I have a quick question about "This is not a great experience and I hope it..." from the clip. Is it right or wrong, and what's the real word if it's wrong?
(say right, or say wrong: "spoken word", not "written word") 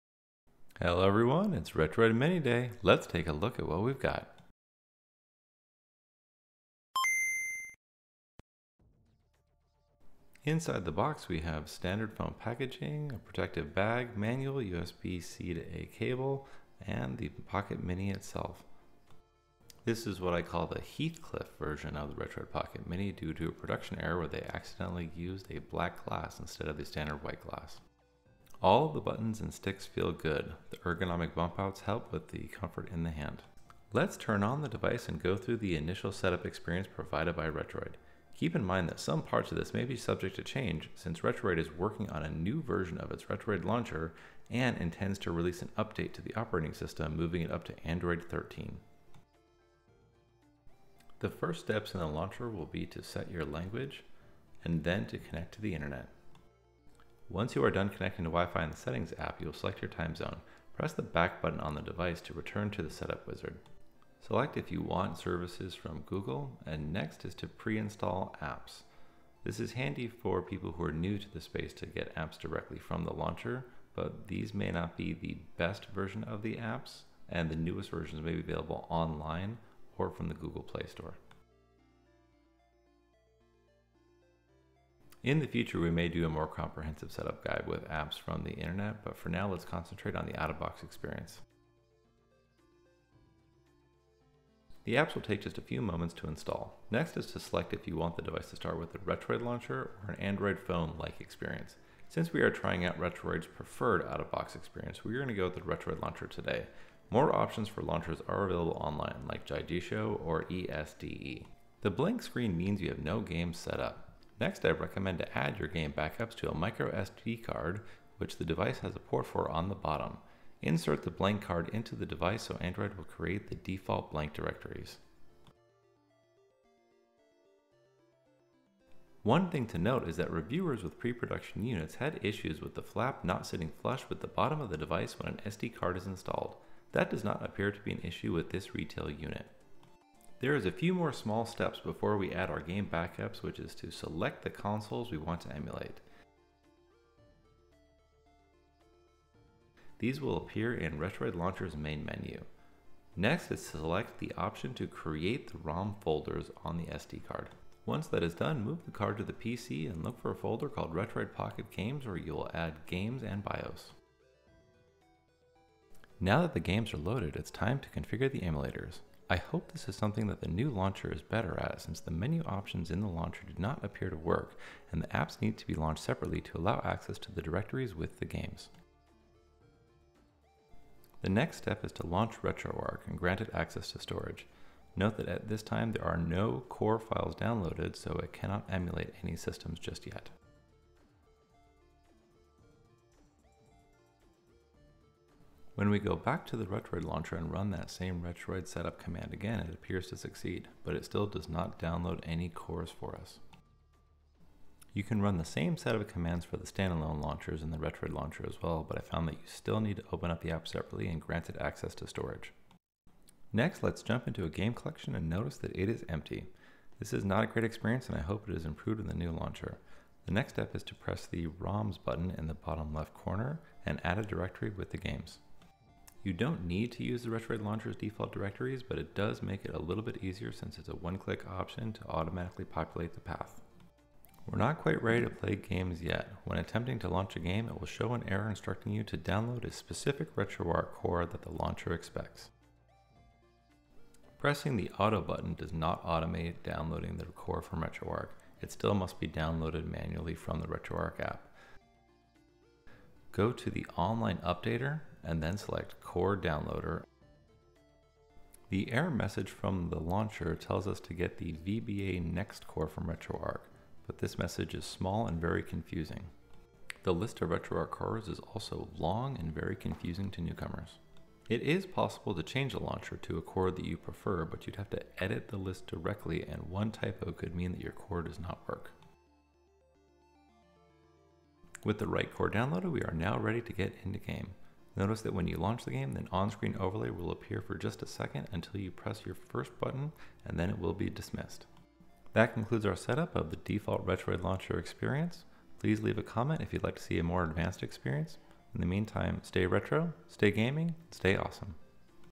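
right.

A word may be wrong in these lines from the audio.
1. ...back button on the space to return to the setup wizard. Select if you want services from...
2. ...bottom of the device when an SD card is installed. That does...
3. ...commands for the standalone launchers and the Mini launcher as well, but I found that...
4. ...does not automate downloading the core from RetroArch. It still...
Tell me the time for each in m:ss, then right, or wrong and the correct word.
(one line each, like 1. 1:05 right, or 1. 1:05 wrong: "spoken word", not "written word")
1. 1:01 wrong: "device", not "space"
2. 2:14 right
3. 3:26 wrong: "Retroid", not "Mini"
4. 4:05 right.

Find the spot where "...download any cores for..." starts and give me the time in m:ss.
3:21.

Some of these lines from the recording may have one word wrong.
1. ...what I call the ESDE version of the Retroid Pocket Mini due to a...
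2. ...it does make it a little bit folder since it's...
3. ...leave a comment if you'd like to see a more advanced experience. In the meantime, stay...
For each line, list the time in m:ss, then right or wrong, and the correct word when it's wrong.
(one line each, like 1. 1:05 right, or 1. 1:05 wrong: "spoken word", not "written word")
1. 0:20 wrong: "Heathcliff", not "ESDE"
2. 3:48 wrong: "easier", not "folder"
3. 4:56 right.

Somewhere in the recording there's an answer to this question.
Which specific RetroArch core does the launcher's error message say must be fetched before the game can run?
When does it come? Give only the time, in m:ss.
4:21.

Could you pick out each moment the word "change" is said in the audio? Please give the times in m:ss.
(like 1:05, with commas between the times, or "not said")
0:40, 4:32.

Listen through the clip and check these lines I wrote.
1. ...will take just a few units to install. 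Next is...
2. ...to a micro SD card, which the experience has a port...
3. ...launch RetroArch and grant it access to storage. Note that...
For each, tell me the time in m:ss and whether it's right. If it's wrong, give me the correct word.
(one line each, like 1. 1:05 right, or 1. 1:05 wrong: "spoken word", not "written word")
1. 1:35 wrong: "moments", not "units"
2. 1:56 wrong: "device", not "experience"
3. 3:02 right.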